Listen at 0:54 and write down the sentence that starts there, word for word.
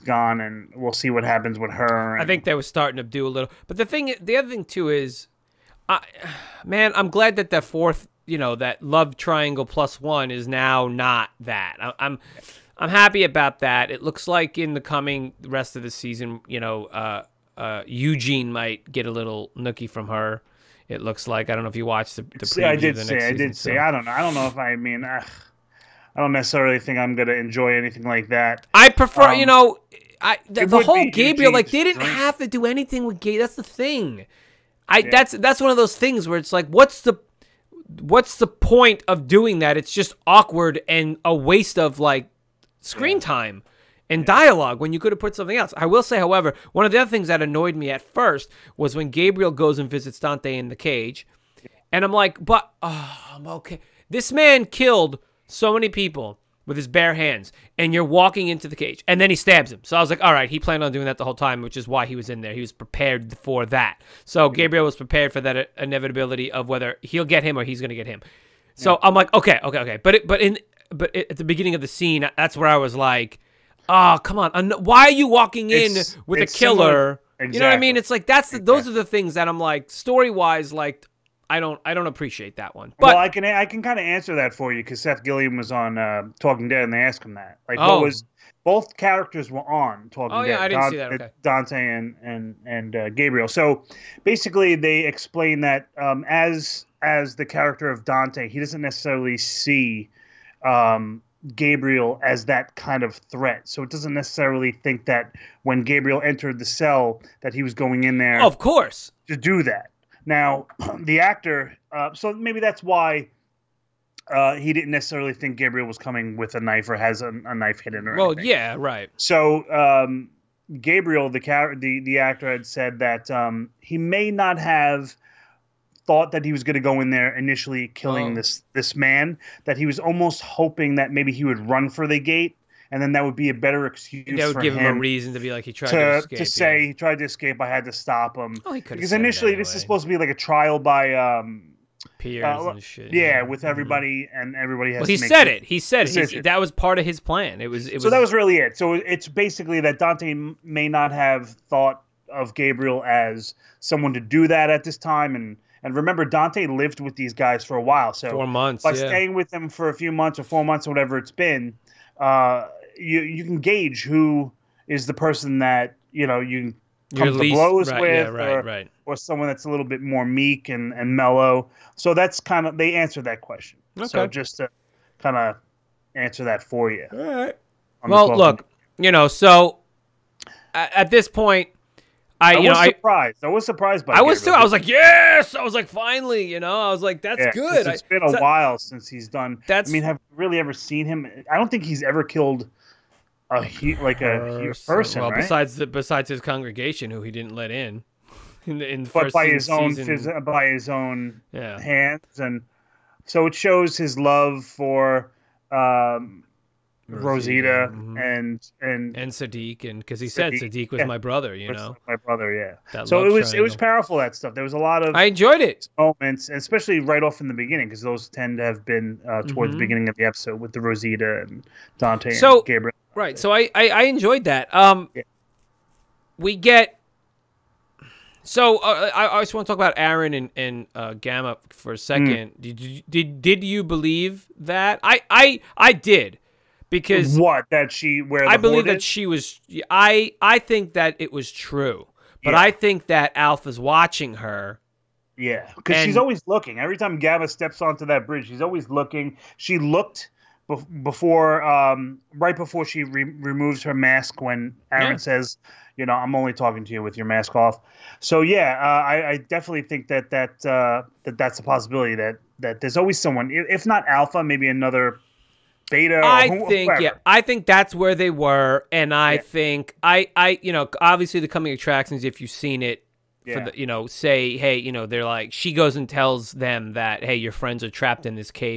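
This man killed so many people with his bare hands, and you're walking into the cage, and then he stabs him.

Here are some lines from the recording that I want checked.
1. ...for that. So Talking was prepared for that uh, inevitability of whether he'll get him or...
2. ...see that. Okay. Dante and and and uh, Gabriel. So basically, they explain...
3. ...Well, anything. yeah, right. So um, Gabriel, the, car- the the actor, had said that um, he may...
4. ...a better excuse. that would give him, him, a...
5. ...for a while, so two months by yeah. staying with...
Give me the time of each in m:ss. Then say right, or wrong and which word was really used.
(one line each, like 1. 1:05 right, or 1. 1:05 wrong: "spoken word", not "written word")
1. 1:03 wrong: "Gabriel", not "Talking"
2. 1:30 right
3. 1:58 right
4. 2:13 right
5. 2:37 wrong: "four", not "two".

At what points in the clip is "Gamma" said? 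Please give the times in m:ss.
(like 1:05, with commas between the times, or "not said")
3:51, 4:07.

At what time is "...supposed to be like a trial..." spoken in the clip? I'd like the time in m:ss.
2:19.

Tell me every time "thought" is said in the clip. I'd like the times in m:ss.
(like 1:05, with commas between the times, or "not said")
2:06, 2:31.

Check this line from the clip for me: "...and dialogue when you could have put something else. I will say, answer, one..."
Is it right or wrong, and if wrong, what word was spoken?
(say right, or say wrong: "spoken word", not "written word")
wrong: "however", not "answer".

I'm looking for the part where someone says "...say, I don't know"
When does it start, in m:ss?
0:23.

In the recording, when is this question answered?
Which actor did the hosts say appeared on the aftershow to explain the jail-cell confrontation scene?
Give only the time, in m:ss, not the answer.
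1:25.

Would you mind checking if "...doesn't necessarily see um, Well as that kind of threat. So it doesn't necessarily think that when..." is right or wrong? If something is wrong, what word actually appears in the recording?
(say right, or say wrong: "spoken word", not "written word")
wrong: "Gabriel", not "Well".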